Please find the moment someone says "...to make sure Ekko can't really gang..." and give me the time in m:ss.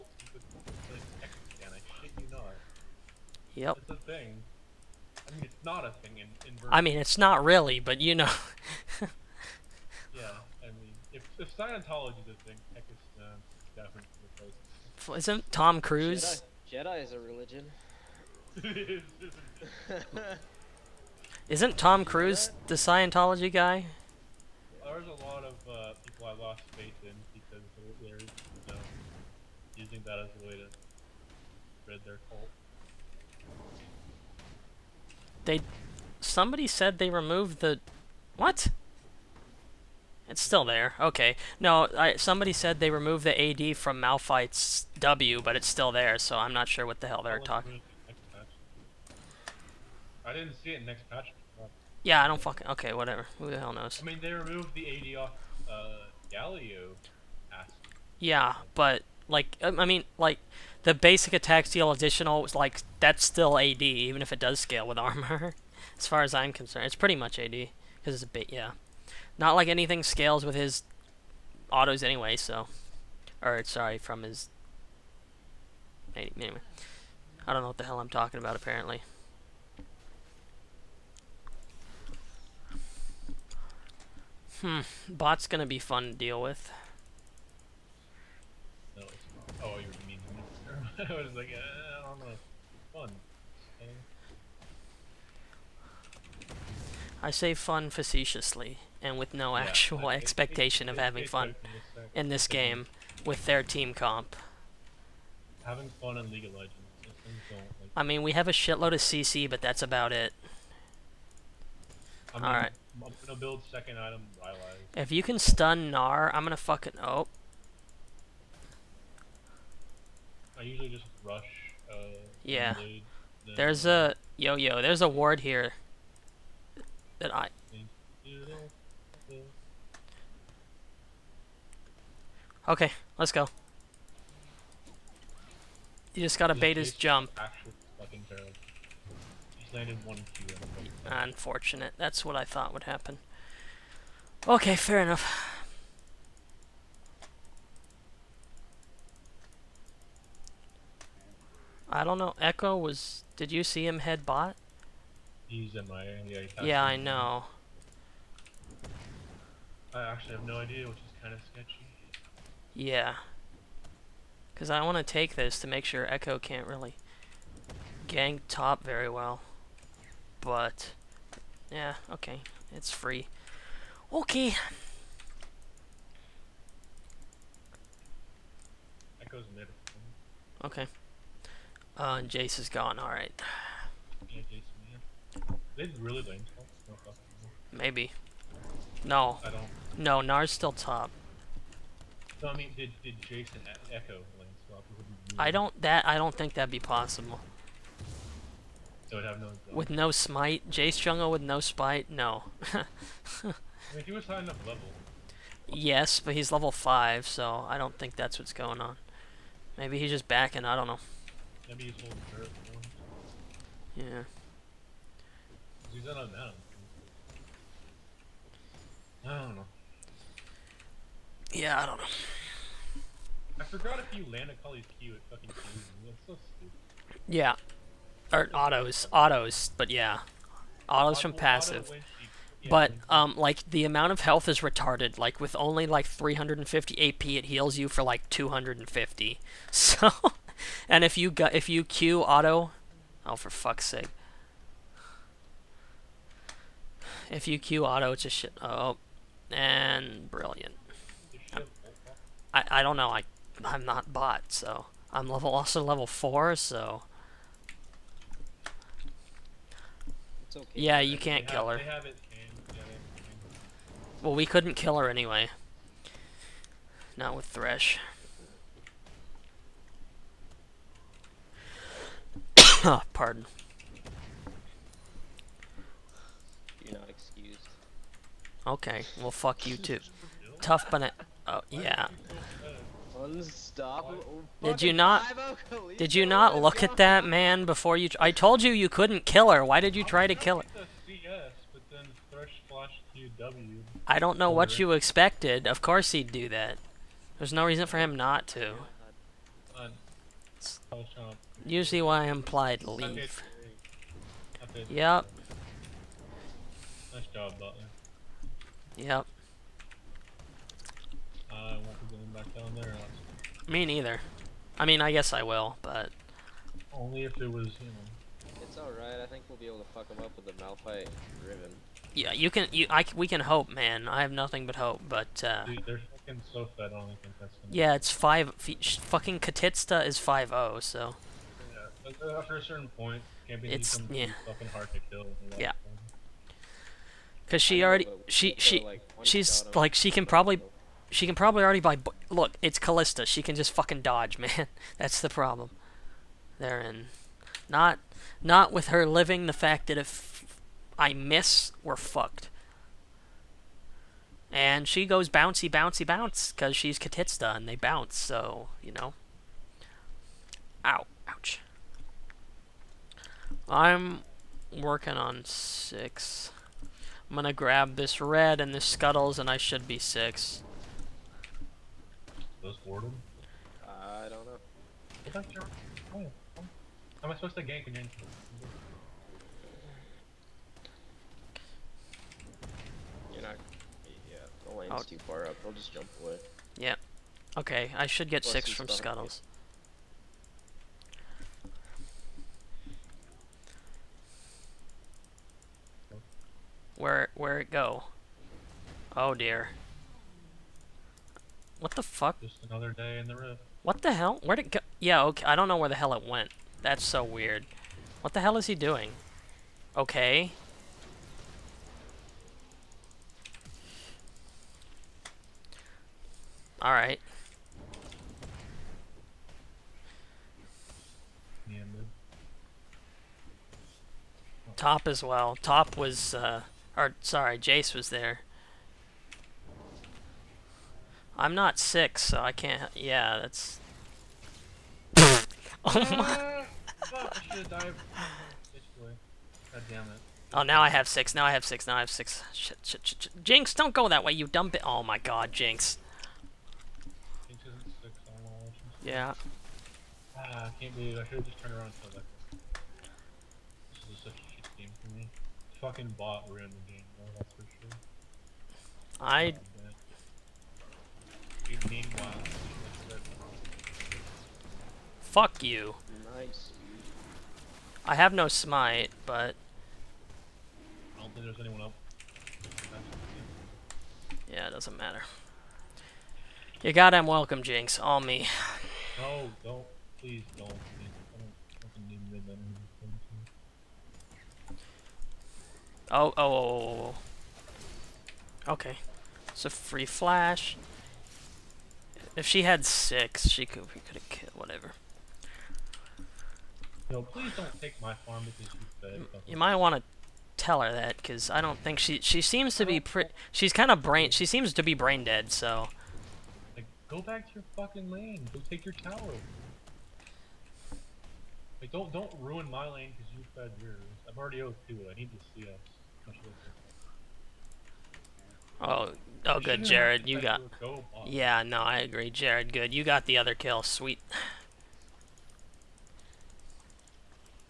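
2:45.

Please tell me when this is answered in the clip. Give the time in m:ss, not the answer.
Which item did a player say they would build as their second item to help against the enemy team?
1:54.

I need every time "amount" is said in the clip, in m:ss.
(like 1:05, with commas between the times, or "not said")
3:53.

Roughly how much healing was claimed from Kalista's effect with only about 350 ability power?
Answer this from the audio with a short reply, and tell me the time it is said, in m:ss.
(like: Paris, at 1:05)
250, at 3:58.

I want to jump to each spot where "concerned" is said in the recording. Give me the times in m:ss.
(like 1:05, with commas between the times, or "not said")
1:06.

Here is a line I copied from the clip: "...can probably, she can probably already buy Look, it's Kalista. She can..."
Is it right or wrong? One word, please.
right.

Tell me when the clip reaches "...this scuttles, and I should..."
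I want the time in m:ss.
6:08.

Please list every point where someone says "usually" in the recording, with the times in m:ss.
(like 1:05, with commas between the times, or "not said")
2:00, 5:01.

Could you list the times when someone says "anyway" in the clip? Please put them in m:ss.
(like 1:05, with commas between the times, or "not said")
1:12, 1:16, 4:25.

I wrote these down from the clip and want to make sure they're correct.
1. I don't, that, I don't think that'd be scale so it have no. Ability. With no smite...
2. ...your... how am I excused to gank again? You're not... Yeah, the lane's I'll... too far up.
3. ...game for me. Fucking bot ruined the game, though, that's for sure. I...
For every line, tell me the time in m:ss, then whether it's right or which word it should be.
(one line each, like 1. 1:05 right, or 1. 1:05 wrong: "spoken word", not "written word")
1. 3:15 wrong: "possible", not "scale"
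2. 6:15 wrong: "supposed", not "excused"
3. 7:34 right.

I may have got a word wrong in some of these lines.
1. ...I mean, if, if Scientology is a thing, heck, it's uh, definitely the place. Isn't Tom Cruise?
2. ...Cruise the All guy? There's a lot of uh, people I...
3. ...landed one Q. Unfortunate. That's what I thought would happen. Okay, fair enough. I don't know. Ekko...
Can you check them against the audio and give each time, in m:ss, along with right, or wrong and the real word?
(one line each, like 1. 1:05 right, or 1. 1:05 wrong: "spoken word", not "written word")
1. 0:10 right
2. 0:22 wrong: "Scientology", not "All"
3. 2:19 right.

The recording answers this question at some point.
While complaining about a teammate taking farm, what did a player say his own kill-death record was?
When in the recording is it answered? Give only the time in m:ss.
8:34.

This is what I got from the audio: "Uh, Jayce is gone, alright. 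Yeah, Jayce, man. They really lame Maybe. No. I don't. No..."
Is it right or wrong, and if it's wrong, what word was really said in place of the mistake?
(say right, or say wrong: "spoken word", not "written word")
right.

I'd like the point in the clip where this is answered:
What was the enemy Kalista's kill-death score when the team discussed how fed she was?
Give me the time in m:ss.
5:30.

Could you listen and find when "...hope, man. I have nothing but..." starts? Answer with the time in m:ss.
5:23.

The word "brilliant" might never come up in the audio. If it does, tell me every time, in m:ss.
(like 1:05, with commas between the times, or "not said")
4:10.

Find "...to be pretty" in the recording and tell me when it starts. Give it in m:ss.
8:22.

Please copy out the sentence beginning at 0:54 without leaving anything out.
I mean, they removed the AD off uh, Galio.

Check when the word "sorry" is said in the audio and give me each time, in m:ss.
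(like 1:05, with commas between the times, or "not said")
1:13, 7:07.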